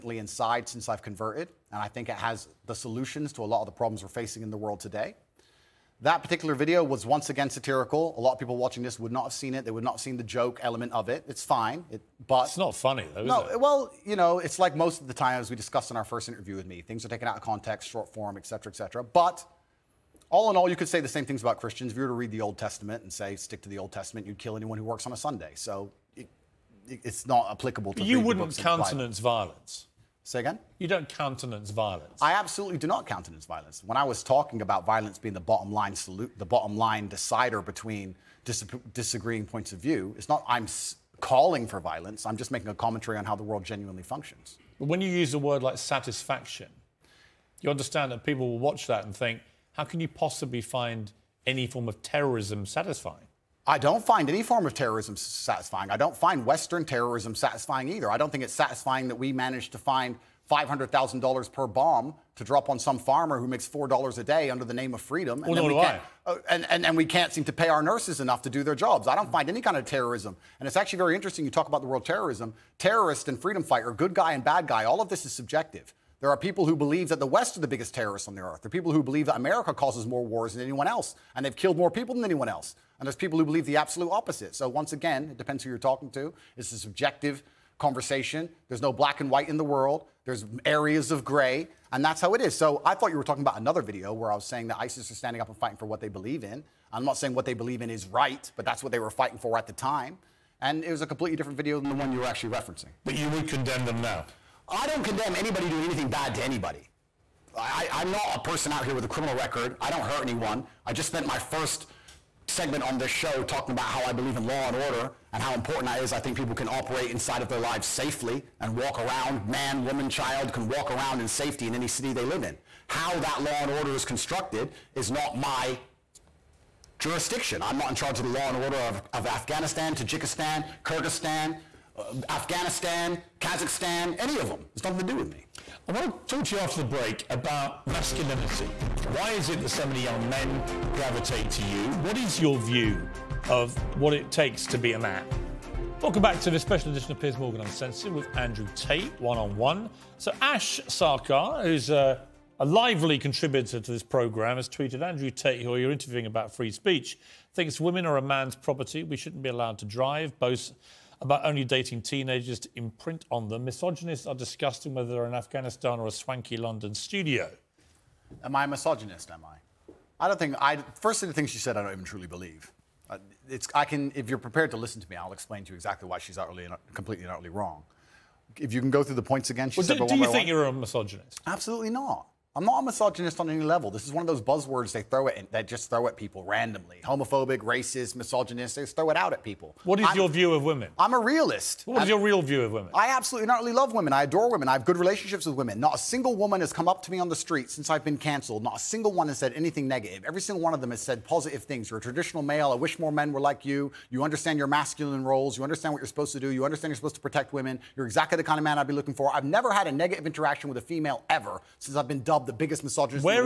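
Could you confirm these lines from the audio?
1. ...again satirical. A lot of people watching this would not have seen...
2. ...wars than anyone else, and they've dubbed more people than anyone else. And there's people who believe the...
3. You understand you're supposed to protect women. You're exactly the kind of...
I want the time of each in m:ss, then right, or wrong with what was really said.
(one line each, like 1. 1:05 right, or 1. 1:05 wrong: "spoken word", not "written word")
1. 0:07 right
2. 1:20 wrong: "killed", not "dubbed"
3. 3:26 right.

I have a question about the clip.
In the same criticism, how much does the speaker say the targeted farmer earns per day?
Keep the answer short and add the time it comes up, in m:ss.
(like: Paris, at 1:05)
$4, at 1:03.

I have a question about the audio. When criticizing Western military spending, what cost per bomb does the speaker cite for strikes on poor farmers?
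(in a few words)
$500,000.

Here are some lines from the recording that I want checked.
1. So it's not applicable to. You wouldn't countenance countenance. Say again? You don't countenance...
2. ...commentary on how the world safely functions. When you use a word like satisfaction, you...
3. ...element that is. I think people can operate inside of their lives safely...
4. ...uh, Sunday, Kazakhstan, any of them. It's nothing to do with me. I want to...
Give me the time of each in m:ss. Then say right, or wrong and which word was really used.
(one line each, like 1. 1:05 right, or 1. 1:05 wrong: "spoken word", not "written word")
1. 0:25 wrong: "violence", not "countenance"
2. 0:42 wrong: "genuinely", not "safely"
3. 1:55 wrong: "important", not "element"
4. 2:11 wrong: "Afghanistan", not "Sunday".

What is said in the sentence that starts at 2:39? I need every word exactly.
We shouldn't be allowed to drive.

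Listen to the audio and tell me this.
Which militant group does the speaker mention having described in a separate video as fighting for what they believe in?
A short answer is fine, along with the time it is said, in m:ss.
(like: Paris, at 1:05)
ISIS, at 1:34.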